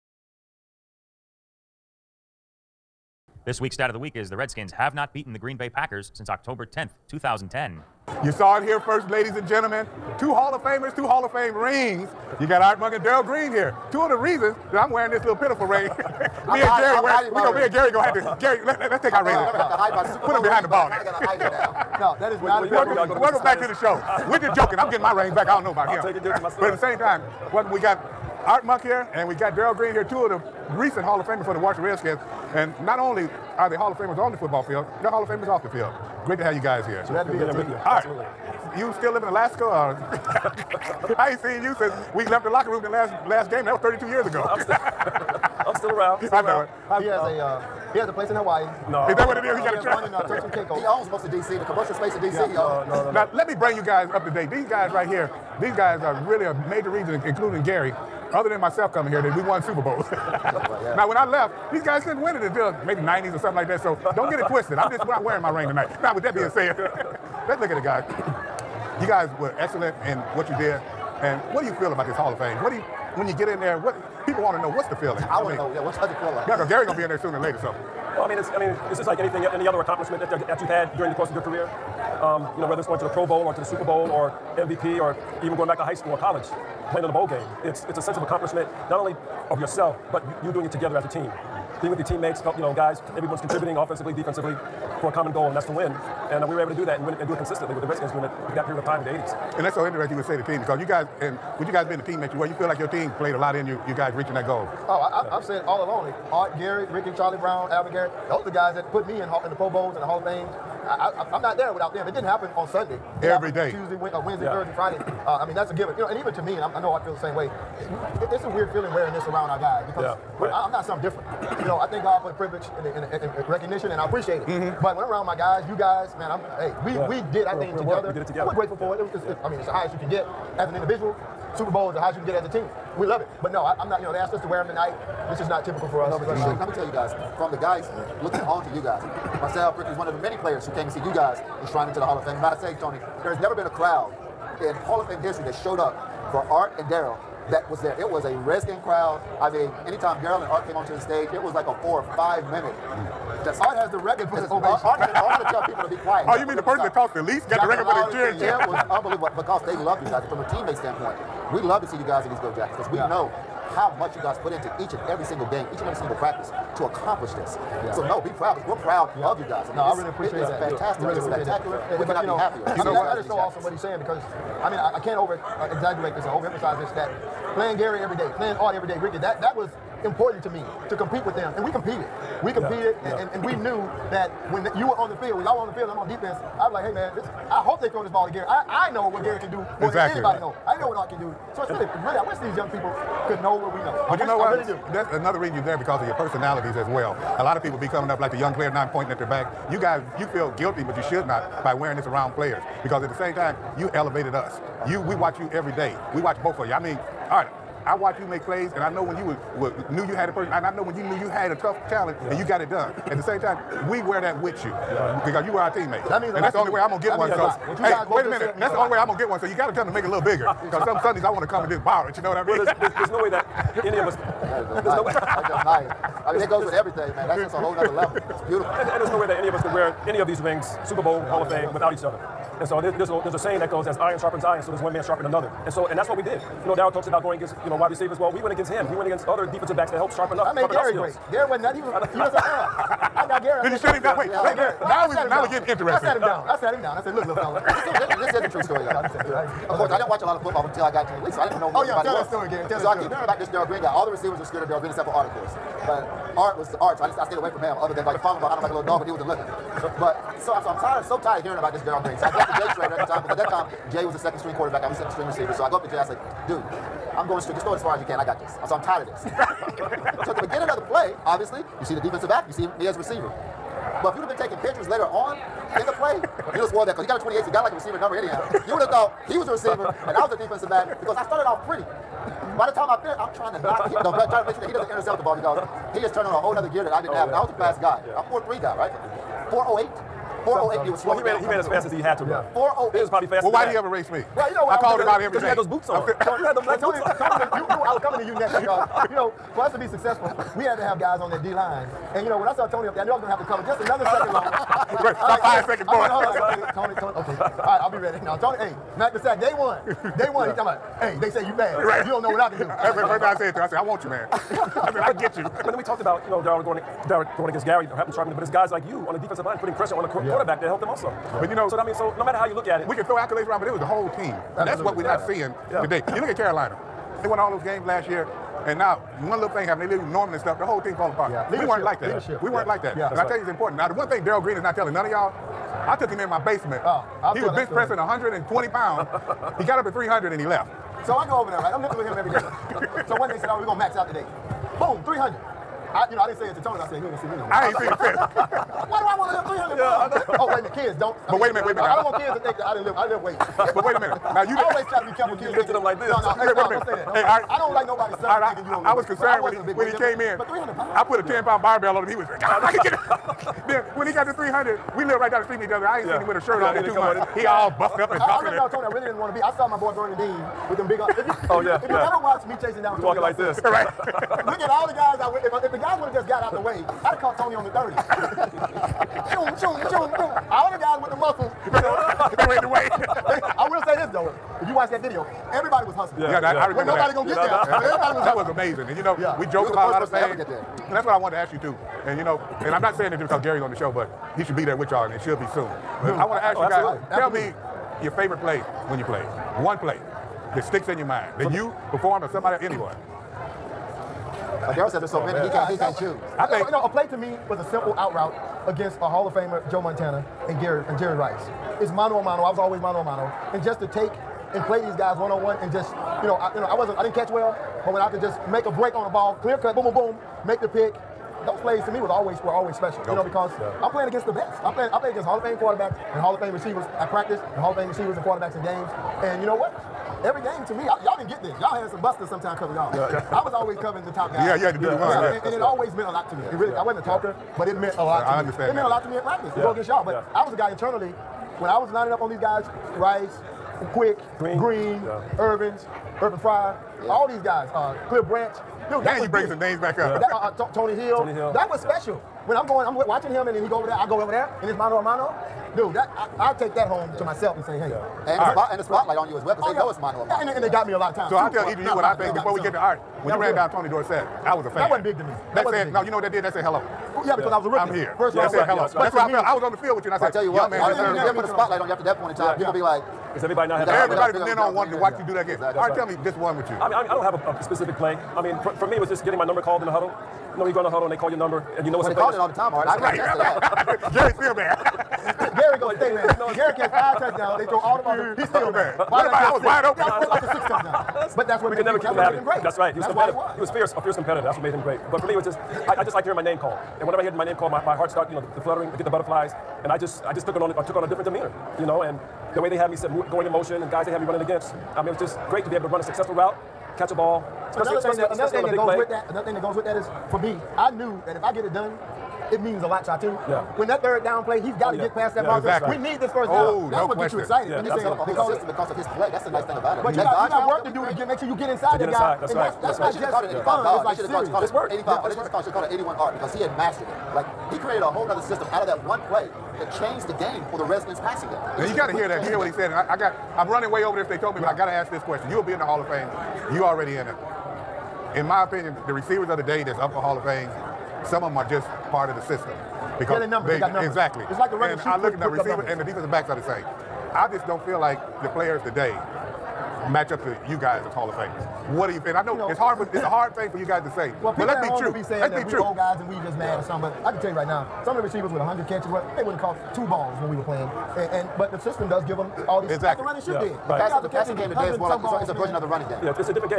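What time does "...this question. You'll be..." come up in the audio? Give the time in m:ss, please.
8:55.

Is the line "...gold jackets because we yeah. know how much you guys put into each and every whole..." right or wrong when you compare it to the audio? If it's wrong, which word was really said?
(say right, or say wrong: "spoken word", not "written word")
wrong: "single", not "whole".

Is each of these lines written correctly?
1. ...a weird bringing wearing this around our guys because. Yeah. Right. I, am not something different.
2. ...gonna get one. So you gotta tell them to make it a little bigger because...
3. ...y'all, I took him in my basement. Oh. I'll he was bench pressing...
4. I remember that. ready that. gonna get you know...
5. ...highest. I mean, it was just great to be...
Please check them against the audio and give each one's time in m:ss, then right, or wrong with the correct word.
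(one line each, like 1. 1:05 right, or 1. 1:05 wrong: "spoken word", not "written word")
1. 1:58 wrong: "feeling", not "bringing"
2. 3:39 right
3. 5:35 right
4. 6:26 wrong: "nobody", not "ready"
5. 8:24 wrong: "against", not "highest".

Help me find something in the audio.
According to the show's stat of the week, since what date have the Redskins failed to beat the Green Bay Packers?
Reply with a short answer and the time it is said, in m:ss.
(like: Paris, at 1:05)
October 10th, 2010, at 0:06.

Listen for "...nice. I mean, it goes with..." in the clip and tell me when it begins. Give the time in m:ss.
3:45.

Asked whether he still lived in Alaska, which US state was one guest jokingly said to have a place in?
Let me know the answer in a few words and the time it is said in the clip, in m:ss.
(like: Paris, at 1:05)
Hawaii, at 0:48.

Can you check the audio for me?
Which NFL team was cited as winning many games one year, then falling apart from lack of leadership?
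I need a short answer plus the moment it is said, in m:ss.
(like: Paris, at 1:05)
Carolina, at 5:26.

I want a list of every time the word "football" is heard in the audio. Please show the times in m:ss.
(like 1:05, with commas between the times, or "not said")
0:34, 4:10.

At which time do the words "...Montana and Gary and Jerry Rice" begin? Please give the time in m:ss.
6:49.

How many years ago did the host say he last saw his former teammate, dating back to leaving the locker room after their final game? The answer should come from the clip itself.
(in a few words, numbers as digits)
32.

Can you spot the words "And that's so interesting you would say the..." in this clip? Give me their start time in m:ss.
1:39.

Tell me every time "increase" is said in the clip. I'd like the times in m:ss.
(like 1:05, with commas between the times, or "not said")
not said.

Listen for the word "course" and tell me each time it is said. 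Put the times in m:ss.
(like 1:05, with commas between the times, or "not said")
1:21, 4:09, 4:15.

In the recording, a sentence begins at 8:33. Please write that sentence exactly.
When that third down play, he's got to oh, yeah.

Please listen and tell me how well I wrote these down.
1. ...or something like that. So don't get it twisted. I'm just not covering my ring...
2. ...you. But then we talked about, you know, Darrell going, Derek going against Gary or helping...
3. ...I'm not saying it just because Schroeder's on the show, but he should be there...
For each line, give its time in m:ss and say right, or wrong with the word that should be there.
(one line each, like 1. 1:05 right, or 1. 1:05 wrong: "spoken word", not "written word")
1. 1:03 wrong: "wearing", not "covering"
2. 5:15 right
3. 6:32 wrong: "Gary", not "Schroeder".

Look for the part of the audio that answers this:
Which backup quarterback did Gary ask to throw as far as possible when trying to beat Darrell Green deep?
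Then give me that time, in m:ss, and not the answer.
4:22.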